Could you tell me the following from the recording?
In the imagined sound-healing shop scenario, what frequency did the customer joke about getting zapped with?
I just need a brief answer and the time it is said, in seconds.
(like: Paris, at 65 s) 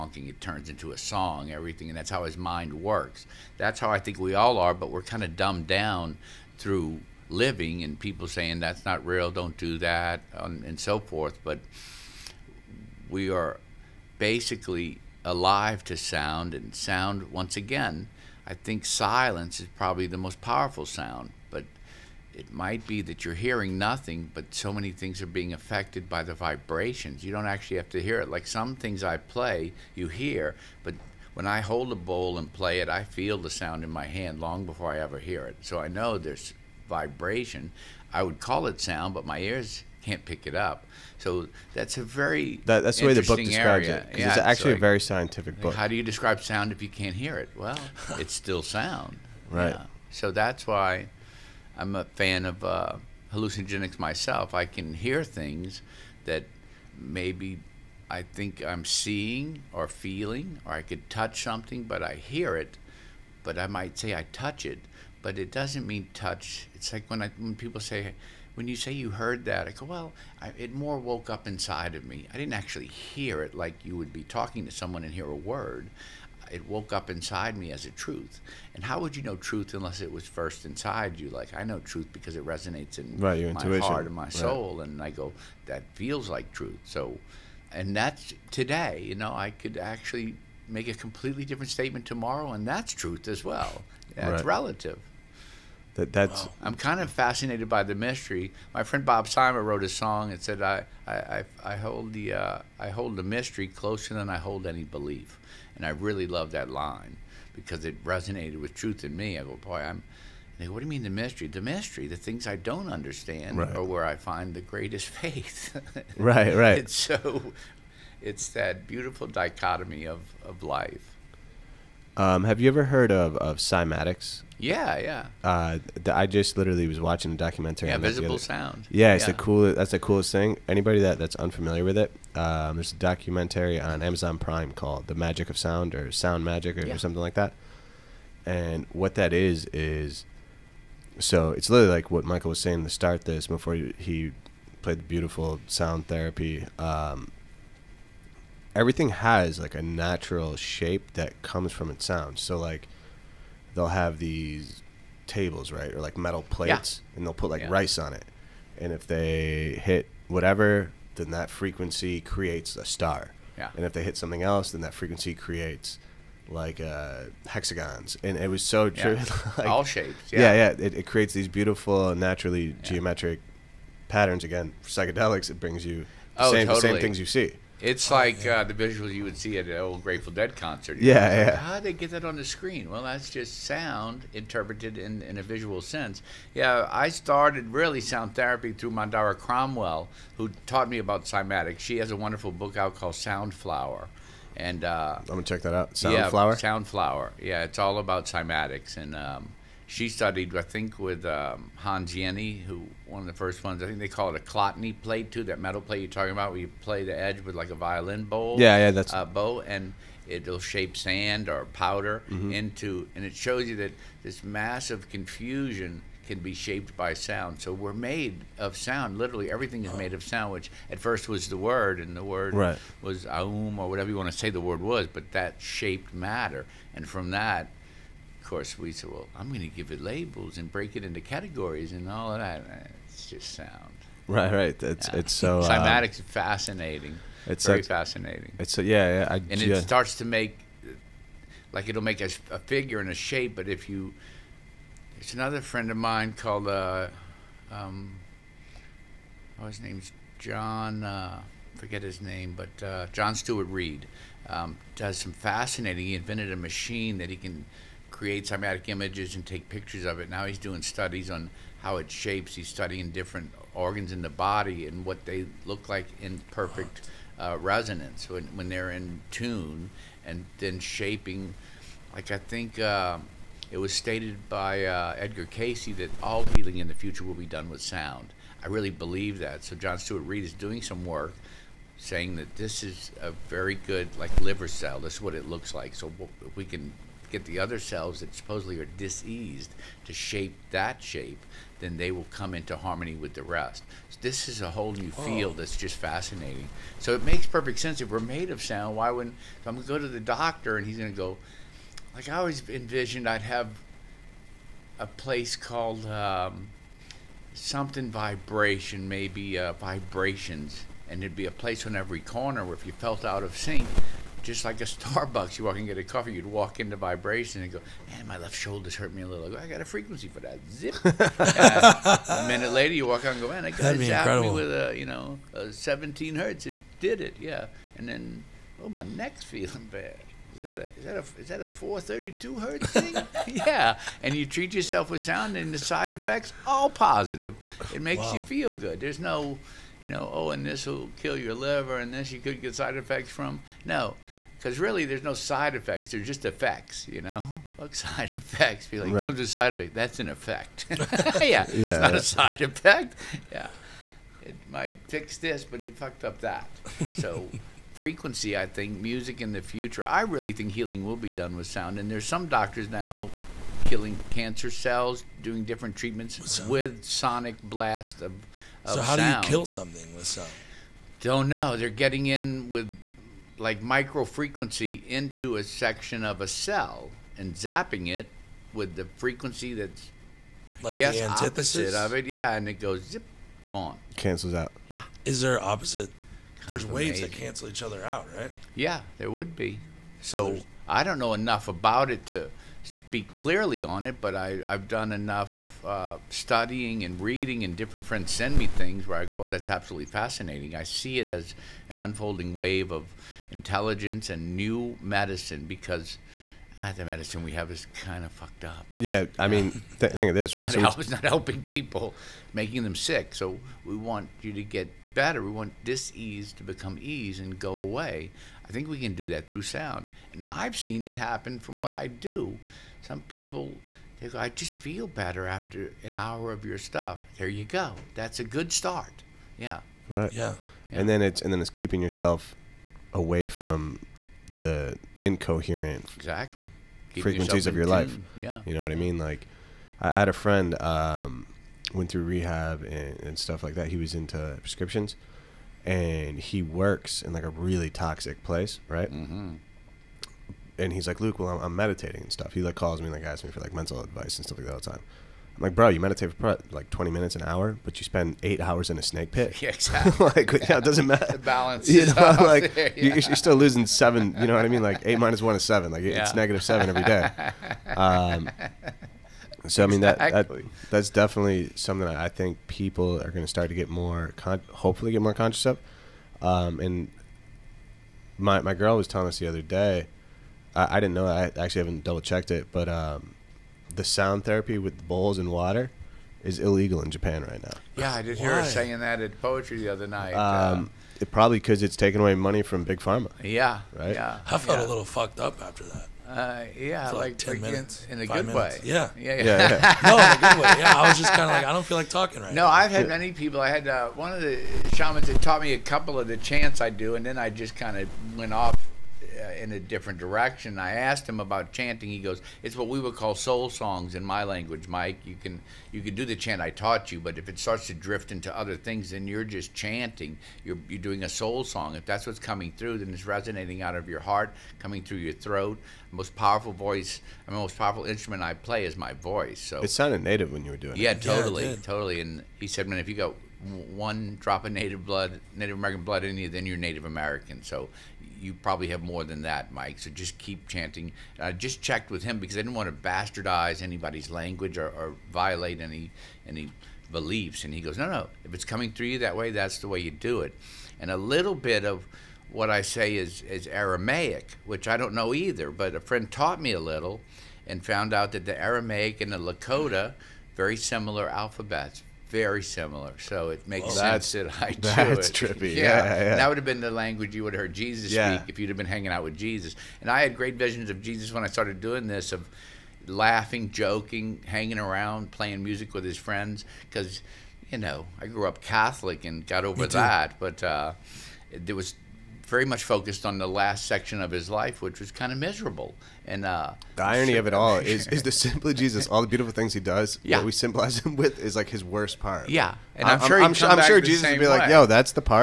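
17 hertz, at 325 s.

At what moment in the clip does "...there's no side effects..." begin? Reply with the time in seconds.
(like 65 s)
345 s.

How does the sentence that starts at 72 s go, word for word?
I didn't actually hear it like you would be talking to someone and hear a word.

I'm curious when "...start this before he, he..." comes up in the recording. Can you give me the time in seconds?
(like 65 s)
142 s.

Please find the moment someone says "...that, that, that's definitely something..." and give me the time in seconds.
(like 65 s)
470 s.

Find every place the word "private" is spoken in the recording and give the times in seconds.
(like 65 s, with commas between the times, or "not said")
not said.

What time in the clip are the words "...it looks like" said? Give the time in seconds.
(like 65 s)
285 s.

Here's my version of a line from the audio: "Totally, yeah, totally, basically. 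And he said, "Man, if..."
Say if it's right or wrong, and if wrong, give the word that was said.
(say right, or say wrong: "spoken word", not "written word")
wrong: "totally", not "basically".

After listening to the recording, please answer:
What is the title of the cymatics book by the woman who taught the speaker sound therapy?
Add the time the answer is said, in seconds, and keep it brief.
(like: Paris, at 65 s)
Sound Flower, at 193 s.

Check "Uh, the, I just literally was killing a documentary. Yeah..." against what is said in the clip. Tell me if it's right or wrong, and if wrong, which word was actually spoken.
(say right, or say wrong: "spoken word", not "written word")
wrong: "watching", not "killing".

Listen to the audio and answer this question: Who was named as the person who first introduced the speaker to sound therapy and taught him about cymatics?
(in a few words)
Mandara Cromwell.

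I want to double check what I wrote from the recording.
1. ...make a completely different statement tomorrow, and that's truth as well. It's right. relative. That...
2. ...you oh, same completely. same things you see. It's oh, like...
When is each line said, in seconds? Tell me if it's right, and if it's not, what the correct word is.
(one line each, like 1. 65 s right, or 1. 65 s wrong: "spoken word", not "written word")
1. 90 s right
2. 175 s wrong: "totally", not "completely".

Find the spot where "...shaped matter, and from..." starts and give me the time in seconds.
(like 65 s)
225 s.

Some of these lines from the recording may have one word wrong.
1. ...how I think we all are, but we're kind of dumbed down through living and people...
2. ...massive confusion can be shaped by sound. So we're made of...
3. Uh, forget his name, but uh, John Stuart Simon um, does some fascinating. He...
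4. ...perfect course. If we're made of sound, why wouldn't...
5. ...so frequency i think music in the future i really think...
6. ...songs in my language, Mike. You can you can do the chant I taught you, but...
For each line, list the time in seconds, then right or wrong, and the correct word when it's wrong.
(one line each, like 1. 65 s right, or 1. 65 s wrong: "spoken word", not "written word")
1. 3 s right
2. 214 s right
3. 251 s wrong: "Reid", not "Simon"
4. 297 s wrong: "sense", not "course"
5. 357 s right
6. 513 s right.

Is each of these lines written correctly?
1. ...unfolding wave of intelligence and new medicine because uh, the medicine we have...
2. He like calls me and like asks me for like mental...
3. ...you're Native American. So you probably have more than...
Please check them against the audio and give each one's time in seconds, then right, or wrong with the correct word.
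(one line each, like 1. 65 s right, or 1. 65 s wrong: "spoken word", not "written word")
1. 401 s right
2. 452 s right
3. 536 s right.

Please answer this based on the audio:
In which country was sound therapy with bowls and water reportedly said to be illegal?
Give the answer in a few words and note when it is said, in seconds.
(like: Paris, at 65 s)
Japan, at 487 s.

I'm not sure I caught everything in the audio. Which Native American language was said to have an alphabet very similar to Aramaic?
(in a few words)
Lakota.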